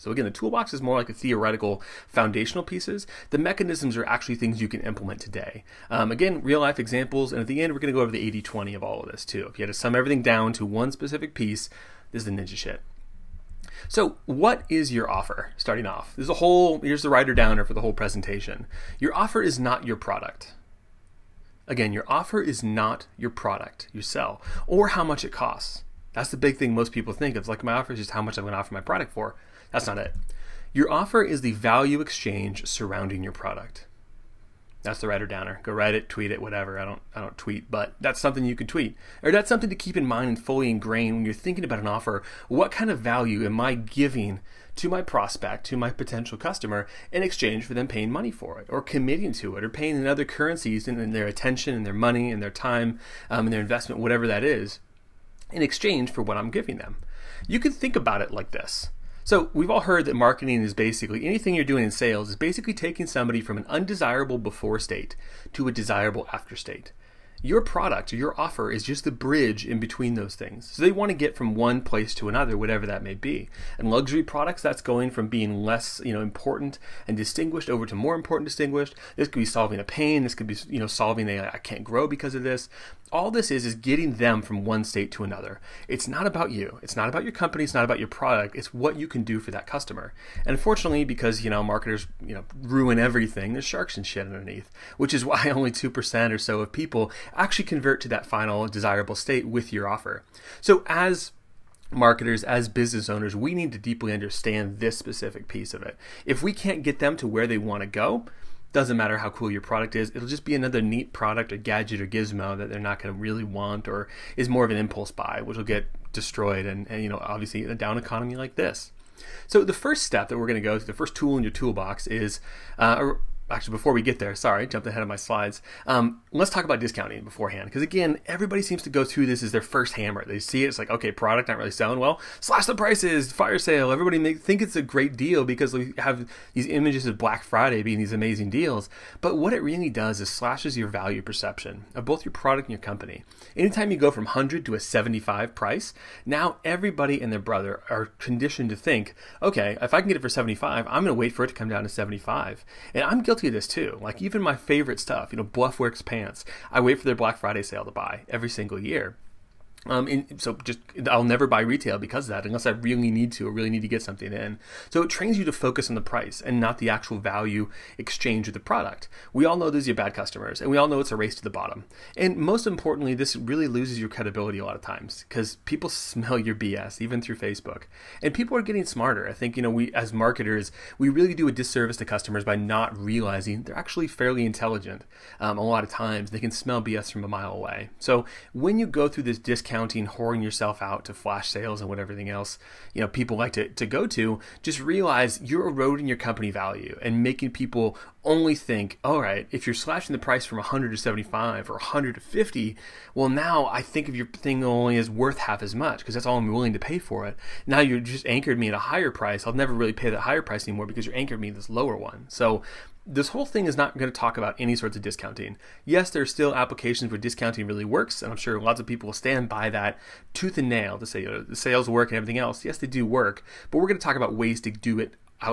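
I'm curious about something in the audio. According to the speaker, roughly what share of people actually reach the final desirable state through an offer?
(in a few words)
2 percent.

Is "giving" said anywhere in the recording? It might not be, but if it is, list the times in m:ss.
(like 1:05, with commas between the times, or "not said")
0:43, 0:56.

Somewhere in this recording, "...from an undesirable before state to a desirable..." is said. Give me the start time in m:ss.
1:03.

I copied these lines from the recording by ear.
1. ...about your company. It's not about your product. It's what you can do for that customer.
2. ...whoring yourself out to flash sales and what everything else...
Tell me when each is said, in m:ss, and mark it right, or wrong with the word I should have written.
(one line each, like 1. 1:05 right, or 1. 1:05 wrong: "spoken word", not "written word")
1. 1:27 right
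2. 3:10 right.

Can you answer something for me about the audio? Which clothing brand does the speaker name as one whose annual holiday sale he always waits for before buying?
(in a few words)
Bluffworks.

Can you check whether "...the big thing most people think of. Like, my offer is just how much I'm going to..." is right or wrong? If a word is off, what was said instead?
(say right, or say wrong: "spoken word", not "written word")
right.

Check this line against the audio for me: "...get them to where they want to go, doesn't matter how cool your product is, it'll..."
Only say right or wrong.
right.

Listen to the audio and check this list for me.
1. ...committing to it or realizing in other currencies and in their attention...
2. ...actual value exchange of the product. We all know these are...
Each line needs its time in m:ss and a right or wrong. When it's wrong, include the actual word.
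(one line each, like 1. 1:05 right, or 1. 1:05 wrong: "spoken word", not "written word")
1. 0:48 wrong: "paying", not "realizing"
2. 2:46 right.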